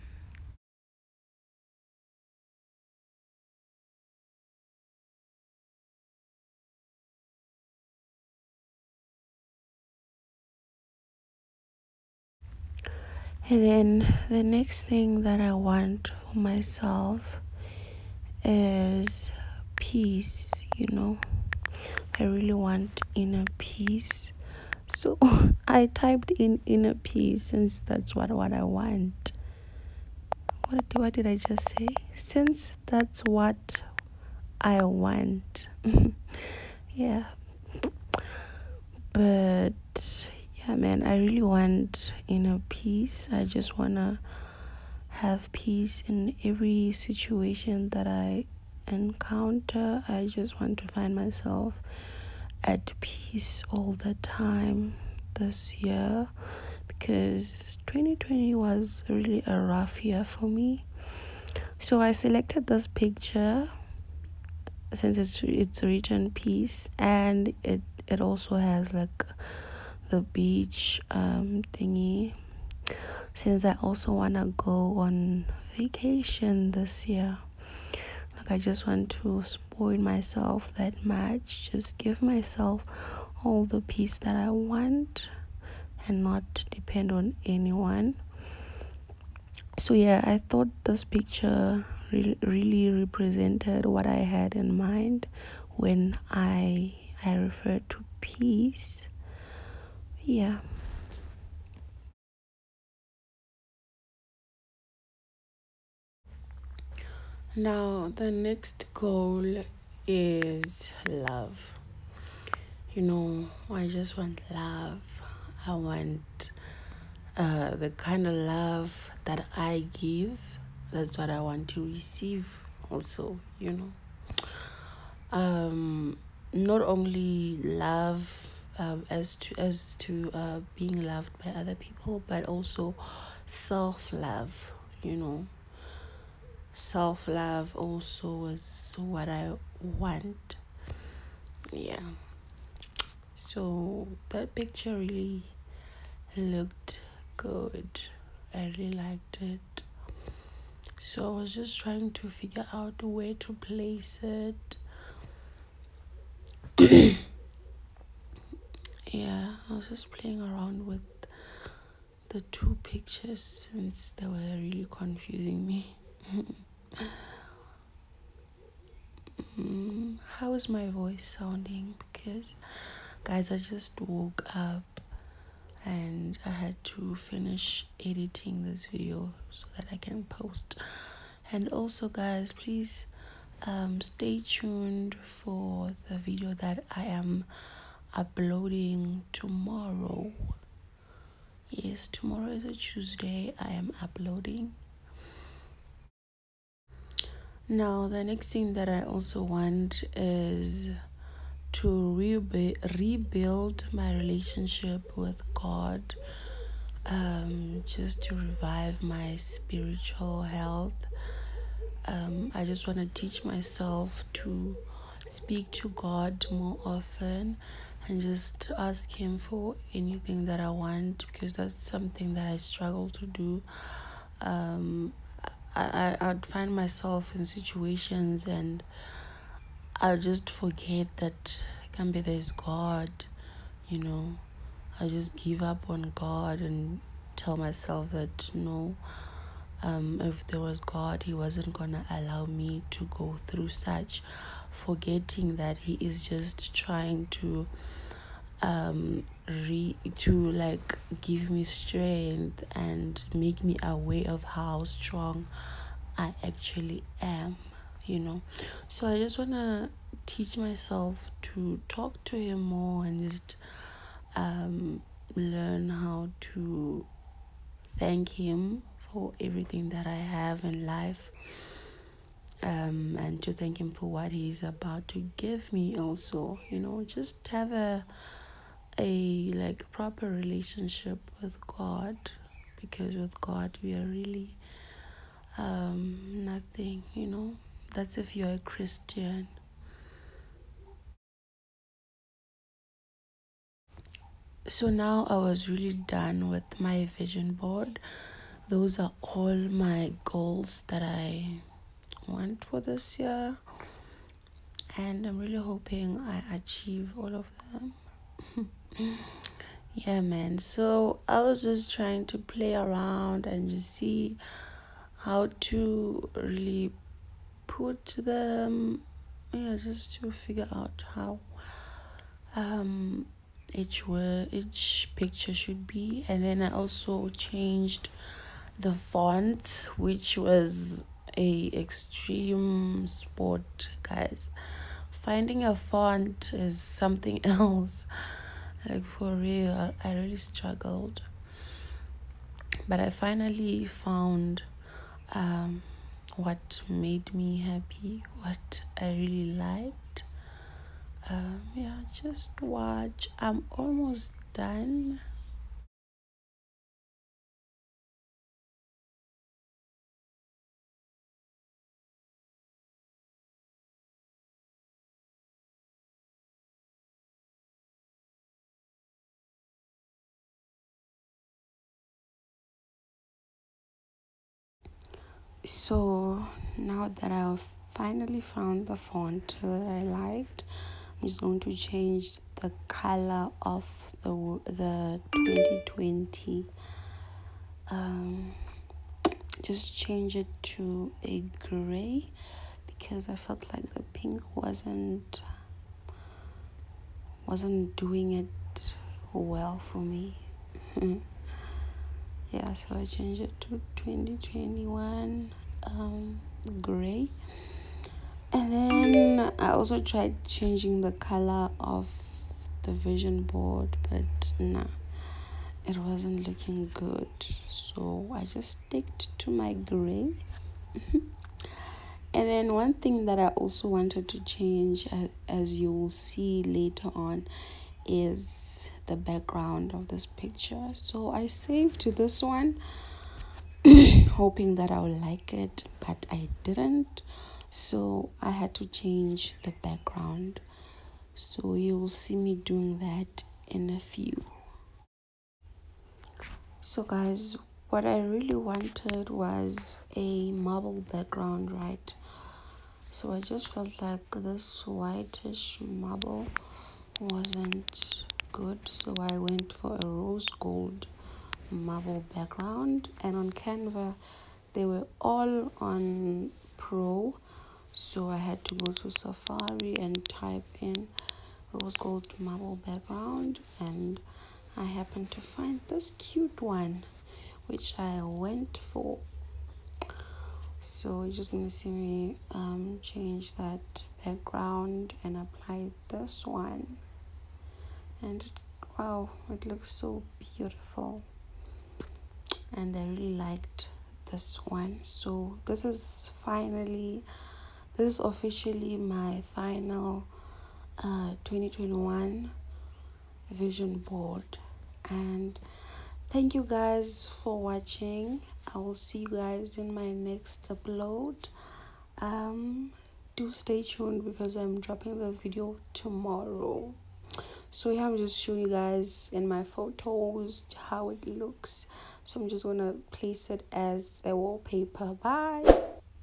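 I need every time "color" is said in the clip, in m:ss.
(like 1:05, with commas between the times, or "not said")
6:22, 6:51.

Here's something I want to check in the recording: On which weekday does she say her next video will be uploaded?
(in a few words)
Tuesday.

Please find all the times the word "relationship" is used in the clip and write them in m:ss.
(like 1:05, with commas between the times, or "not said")
3:24, 4:40.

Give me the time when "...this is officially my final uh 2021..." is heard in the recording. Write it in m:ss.
8:17.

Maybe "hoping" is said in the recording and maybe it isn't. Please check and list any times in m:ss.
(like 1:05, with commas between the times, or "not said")
5:05, 7:14.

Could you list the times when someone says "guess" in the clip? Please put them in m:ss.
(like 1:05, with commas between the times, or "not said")
not said.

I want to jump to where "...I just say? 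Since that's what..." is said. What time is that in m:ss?
0:31.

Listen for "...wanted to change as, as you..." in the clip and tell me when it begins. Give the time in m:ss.
7:03.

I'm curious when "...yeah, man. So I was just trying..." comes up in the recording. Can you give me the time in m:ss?
5:09.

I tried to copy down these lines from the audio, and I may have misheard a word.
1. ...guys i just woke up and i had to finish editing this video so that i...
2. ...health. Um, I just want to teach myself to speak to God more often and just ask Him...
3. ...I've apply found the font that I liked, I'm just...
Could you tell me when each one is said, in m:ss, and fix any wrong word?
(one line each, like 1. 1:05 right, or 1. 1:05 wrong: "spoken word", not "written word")
1. 2:53 right
2. 3:30 right
3. 6:17 wrong: "finally", not "apply".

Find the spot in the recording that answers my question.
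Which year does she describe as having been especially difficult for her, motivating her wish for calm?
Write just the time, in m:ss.
0:57.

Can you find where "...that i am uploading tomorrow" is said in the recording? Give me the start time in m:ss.
3:06.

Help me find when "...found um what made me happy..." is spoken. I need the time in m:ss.
5:43.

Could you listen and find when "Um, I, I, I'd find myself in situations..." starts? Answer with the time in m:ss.
3:44.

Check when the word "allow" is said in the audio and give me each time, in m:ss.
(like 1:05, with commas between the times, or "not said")
4:02.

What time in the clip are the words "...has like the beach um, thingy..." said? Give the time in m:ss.
1:08.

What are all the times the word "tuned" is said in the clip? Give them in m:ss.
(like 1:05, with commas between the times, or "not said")
3:04, 8:33.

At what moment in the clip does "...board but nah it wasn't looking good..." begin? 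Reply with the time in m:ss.
6:53.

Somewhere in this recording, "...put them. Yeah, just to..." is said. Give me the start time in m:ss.
5:17.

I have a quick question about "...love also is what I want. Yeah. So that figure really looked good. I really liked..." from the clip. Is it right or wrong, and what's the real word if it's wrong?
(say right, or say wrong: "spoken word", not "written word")
wrong: "picture", not "figure".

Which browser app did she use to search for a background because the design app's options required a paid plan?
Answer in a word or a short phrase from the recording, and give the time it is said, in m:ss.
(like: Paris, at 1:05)
Safari, at 7:49.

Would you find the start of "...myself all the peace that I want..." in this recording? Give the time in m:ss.
1:22.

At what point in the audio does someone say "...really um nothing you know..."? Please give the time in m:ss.
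4:44.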